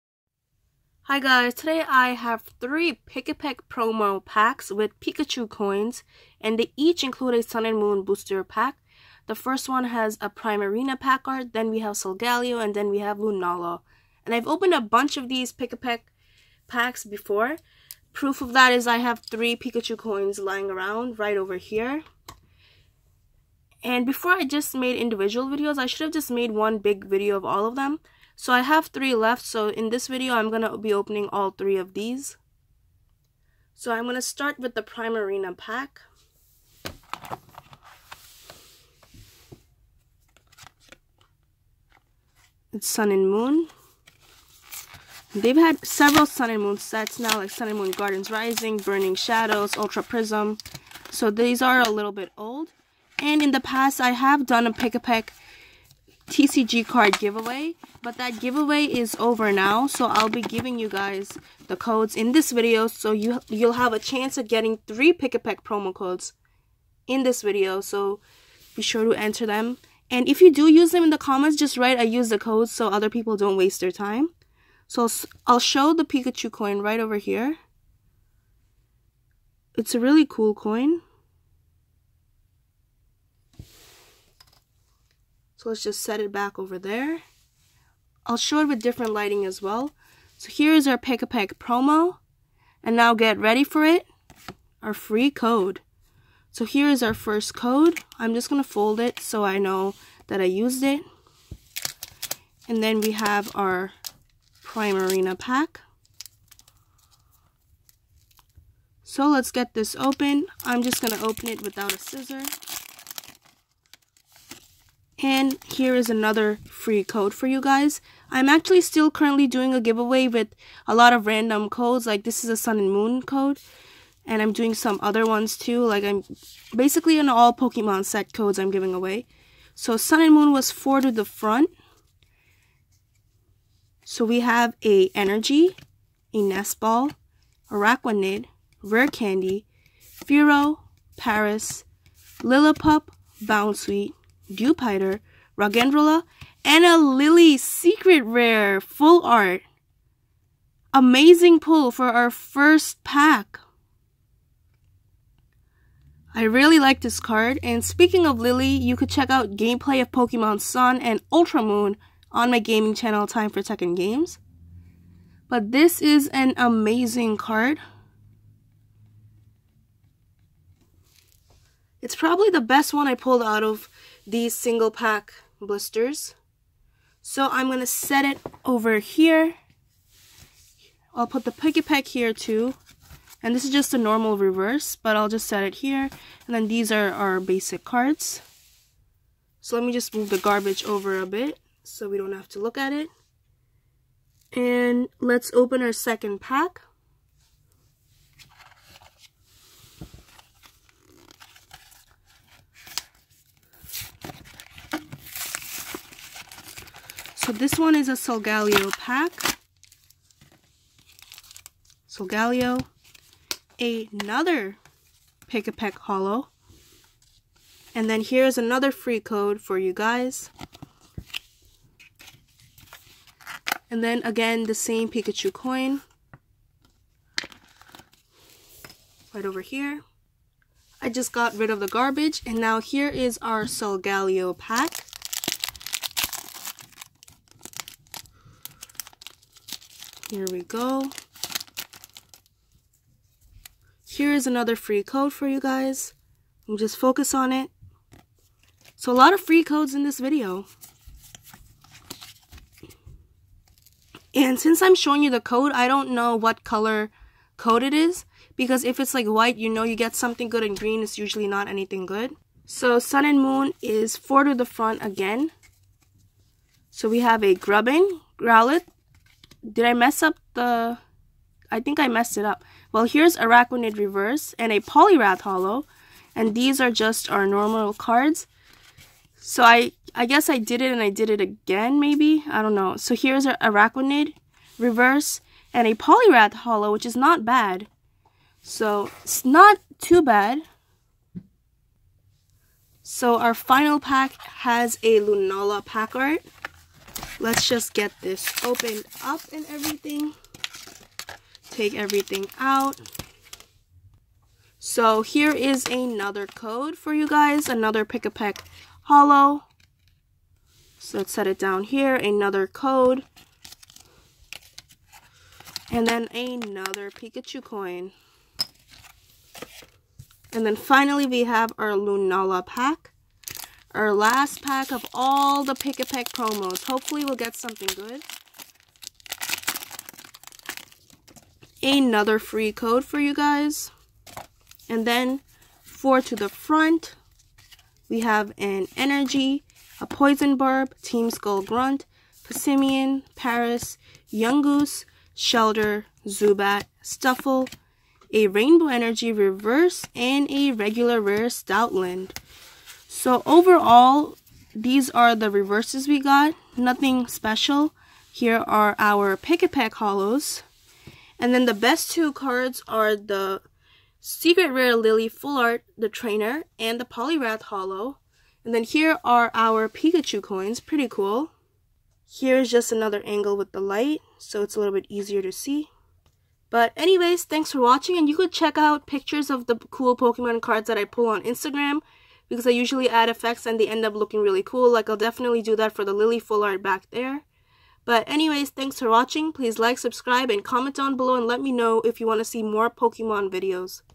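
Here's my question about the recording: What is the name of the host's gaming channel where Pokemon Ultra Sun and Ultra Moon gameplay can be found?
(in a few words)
Time for Tekken Games.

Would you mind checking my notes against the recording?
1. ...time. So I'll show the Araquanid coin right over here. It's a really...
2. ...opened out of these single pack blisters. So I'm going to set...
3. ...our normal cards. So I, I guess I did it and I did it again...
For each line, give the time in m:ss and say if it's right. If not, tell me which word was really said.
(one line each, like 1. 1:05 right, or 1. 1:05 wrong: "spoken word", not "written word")
1. 1:13 wrong: "Pikachu", not "Araquanid"
2. 2:53 wrong: "pulled", not "opened"
3. 4:37 right.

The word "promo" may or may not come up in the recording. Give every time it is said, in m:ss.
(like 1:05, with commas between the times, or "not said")
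0:03, 1:05, 1:31, 5:26.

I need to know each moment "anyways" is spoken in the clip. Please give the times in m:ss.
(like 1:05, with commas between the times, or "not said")
6:16, 6:28.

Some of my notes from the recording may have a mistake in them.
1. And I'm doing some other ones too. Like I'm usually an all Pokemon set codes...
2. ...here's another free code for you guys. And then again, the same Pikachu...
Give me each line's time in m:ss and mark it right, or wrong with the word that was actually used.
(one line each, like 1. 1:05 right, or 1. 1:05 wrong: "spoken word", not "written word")
1. 2:04 wrong: "basically", not "usually"
2. 3:38 right.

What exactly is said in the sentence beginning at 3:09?
So let me just move the garbage over a bit so we don't have to look at it.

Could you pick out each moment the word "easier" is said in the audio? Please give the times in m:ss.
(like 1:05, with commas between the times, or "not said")
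6:15.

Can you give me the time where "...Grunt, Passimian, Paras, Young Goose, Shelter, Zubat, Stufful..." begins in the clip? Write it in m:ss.
5:41.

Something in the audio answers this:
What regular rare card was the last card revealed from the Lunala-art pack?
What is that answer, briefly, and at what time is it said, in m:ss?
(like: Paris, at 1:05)
Stoutland, at 5:51.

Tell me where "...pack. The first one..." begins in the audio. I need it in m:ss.
0:08.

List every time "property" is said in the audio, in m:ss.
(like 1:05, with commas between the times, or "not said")
not said.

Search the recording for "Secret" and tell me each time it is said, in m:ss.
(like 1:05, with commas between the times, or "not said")
2:27, 6:04.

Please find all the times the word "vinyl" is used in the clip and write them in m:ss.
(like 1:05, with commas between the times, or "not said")
not said.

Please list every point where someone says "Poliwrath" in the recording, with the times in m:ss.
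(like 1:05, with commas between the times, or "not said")
4:34, 4:45, 6:07.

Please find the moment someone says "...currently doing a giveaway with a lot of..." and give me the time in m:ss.
1:59.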